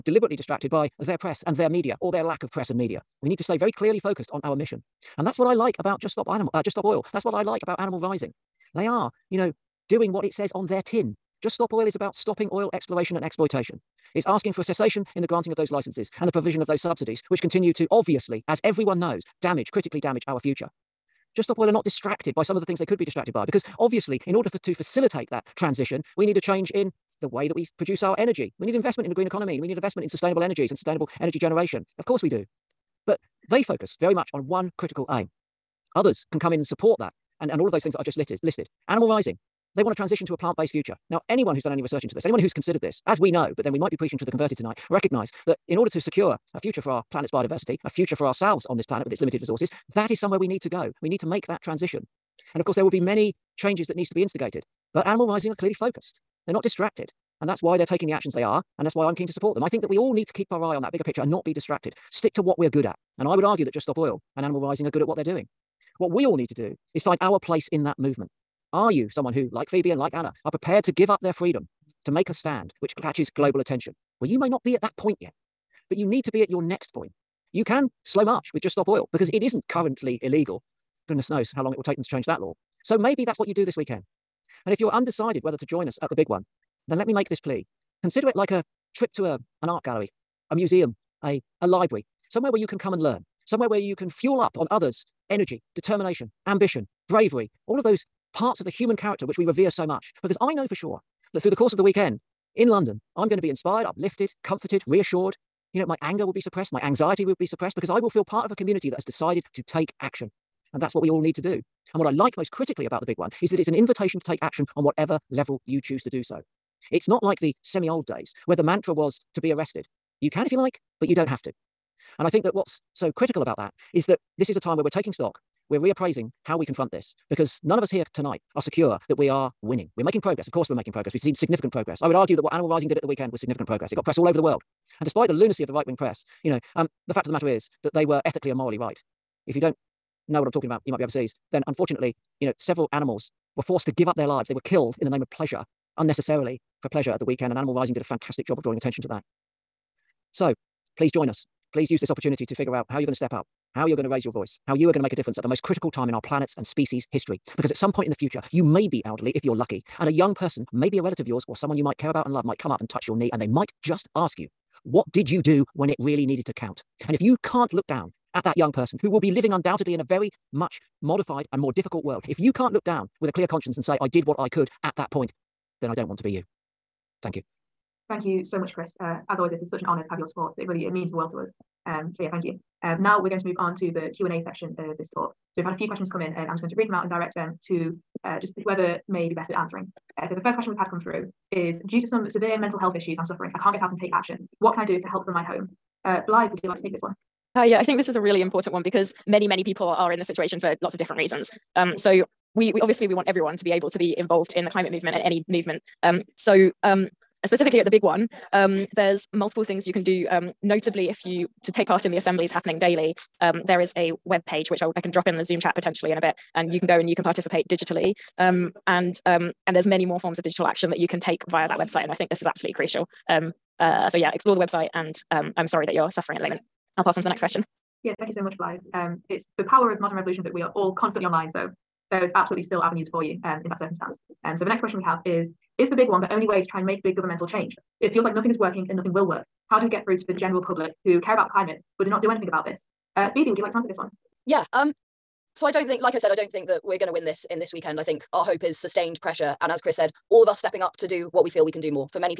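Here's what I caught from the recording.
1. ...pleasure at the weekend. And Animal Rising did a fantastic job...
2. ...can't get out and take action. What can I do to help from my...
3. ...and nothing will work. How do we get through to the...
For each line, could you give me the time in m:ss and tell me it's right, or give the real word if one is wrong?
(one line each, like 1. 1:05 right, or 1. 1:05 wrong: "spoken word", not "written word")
1. 2:26 right
2. 3:13 right
3. 3:58 right.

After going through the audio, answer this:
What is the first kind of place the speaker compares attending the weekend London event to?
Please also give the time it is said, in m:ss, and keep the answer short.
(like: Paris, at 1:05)
an art gallery, at 1:29.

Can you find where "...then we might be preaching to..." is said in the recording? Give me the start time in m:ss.
0:43.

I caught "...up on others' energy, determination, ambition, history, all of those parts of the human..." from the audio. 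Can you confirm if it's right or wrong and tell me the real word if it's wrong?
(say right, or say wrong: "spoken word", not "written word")
wrong: "bravery", not "history".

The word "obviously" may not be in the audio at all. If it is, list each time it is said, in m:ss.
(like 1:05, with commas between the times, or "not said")
0:17, 0:23, 3:22.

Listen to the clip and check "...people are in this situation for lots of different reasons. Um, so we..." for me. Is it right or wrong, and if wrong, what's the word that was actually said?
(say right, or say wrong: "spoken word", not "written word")
right.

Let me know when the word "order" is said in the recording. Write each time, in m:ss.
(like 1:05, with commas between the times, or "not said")
0:24, 0:45.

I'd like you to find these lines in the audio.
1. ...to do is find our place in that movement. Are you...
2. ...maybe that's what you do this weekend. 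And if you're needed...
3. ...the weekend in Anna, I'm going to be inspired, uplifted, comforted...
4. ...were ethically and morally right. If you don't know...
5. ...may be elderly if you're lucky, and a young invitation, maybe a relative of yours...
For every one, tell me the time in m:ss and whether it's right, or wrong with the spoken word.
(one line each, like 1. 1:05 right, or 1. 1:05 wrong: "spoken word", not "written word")
1. 1:06 right
2. 1:22 wrong: "undecided", not "needed"
3. 1:41 wrong: "London", not "Anna"
4. 2:18 right
5. 2:38 wrong: "person", not "invitation".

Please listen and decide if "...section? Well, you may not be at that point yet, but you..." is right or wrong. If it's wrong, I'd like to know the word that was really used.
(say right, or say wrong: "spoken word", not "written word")
wrong: "attention", not "section".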